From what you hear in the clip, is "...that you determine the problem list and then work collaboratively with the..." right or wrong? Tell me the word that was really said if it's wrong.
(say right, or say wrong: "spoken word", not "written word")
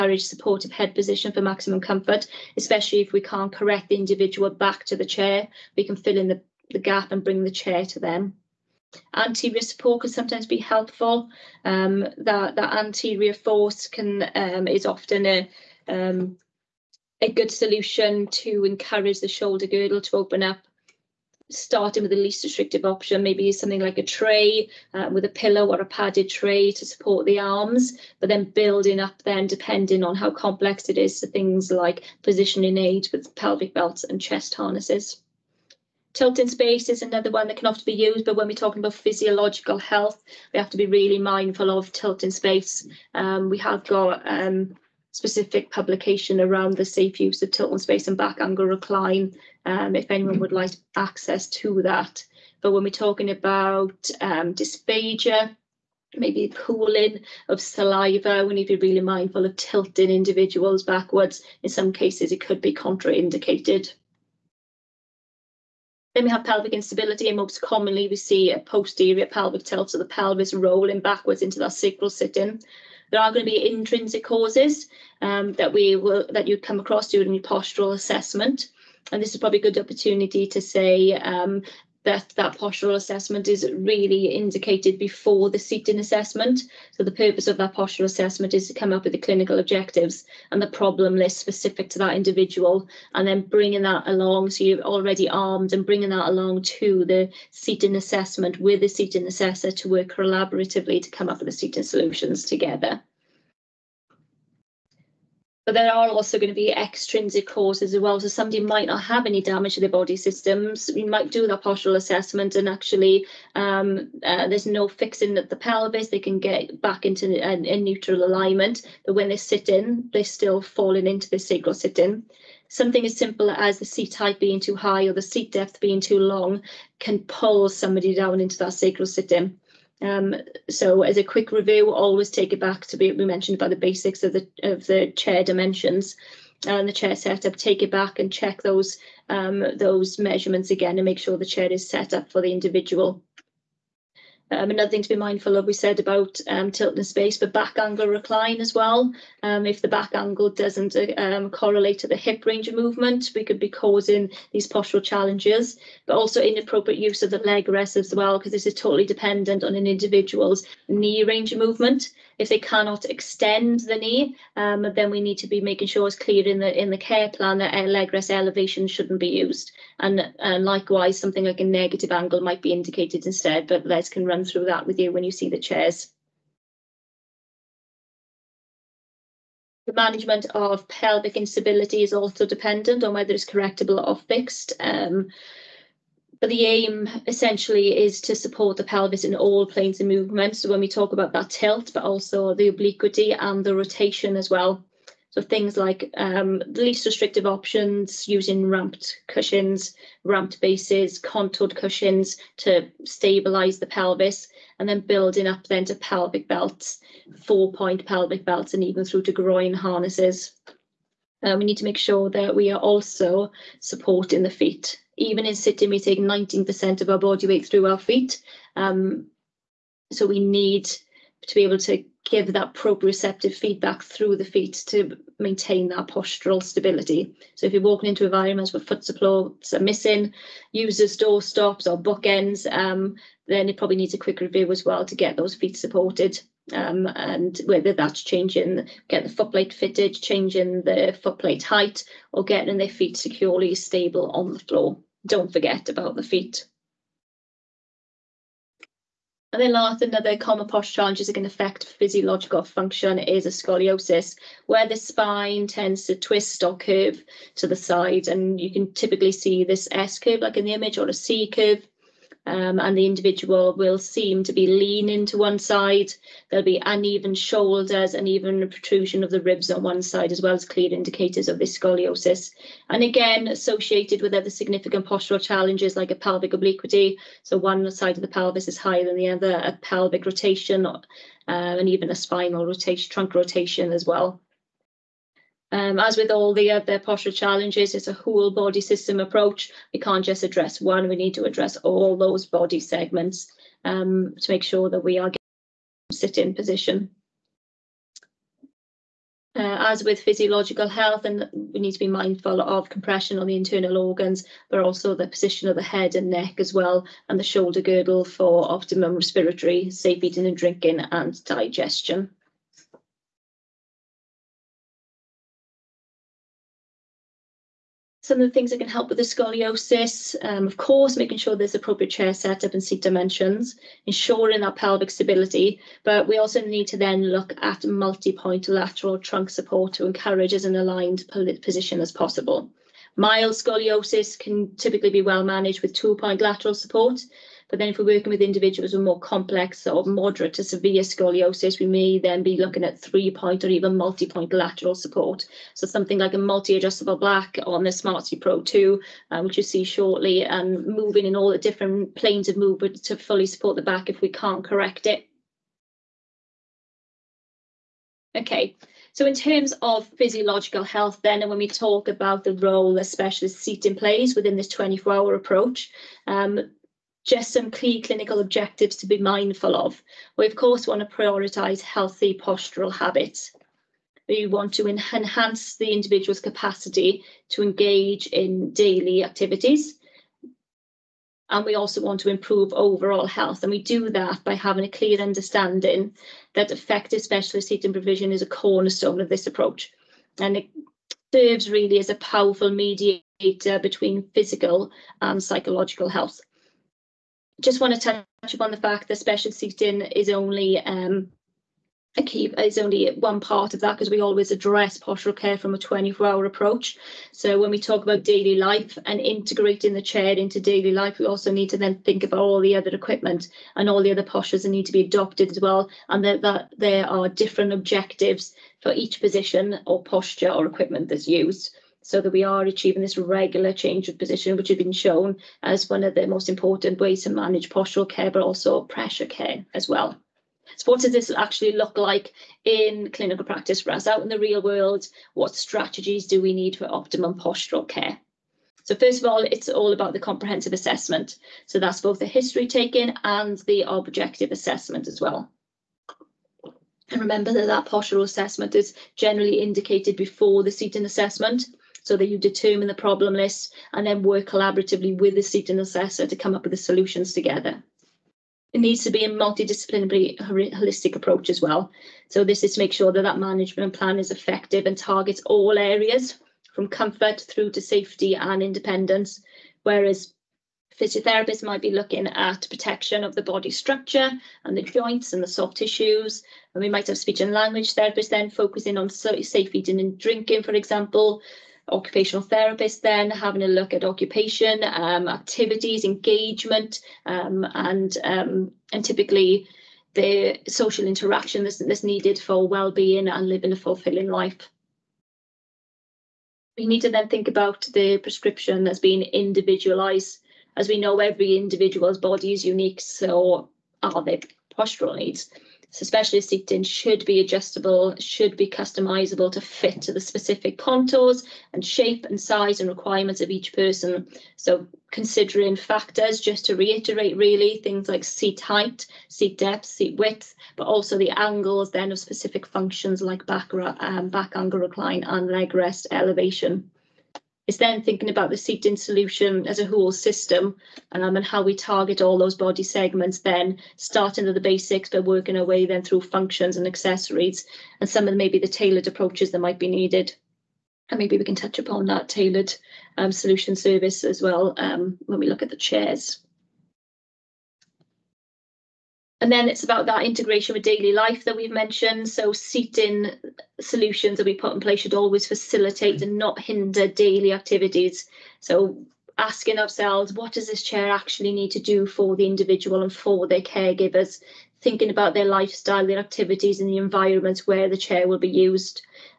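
right.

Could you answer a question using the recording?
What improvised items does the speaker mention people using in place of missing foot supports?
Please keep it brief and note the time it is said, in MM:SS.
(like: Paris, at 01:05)
door stops or bookends, at 03:51.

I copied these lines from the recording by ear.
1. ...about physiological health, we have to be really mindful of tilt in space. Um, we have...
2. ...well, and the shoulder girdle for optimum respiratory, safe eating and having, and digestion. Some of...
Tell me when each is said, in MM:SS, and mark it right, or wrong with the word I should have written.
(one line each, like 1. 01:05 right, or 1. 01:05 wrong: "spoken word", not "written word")
1. 00:38 right
2. 05:06 wrong: "drinking", not "having".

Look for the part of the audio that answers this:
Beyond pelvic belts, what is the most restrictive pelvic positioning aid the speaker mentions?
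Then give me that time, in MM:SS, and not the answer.
03:29.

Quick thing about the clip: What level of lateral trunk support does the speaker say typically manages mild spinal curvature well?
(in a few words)
two-point lateral support.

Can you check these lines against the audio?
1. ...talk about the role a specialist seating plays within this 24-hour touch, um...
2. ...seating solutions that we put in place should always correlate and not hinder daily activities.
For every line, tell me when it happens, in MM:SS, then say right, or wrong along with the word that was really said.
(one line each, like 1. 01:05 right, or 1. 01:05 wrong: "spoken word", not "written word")
1. 06:01 wrong: "approach", not "touch"
2. 09:12 wrong: "facilitate", not "correlate".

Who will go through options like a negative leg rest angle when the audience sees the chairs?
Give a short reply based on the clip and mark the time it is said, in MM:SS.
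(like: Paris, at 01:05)
Les, at 02:53.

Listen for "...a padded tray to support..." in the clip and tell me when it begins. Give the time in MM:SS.
00:25.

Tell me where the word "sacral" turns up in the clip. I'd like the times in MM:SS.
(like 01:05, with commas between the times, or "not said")
01:11, 02:01, 02:08.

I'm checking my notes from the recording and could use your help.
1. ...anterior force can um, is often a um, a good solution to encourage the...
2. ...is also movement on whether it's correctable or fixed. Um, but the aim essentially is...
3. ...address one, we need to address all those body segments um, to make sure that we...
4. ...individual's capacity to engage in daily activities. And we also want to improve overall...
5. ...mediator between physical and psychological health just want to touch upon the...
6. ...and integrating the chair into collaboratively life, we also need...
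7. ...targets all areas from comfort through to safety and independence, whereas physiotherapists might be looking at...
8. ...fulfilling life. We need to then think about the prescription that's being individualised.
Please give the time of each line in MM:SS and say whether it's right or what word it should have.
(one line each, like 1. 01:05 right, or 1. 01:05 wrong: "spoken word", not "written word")
1. 00:12 right
2. 03:02 wrong: "dependent", not "movement"
3. 04:50 right
4. 06:15 right
5. 06:32 right
6. 06:49 wrong: "daily", not "collaboratively"
7. 07:44 right
8. 08:13 right.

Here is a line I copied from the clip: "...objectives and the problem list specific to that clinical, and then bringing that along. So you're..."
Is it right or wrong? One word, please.
wrong.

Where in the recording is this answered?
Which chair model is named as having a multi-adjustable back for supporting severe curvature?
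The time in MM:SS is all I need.
05:47.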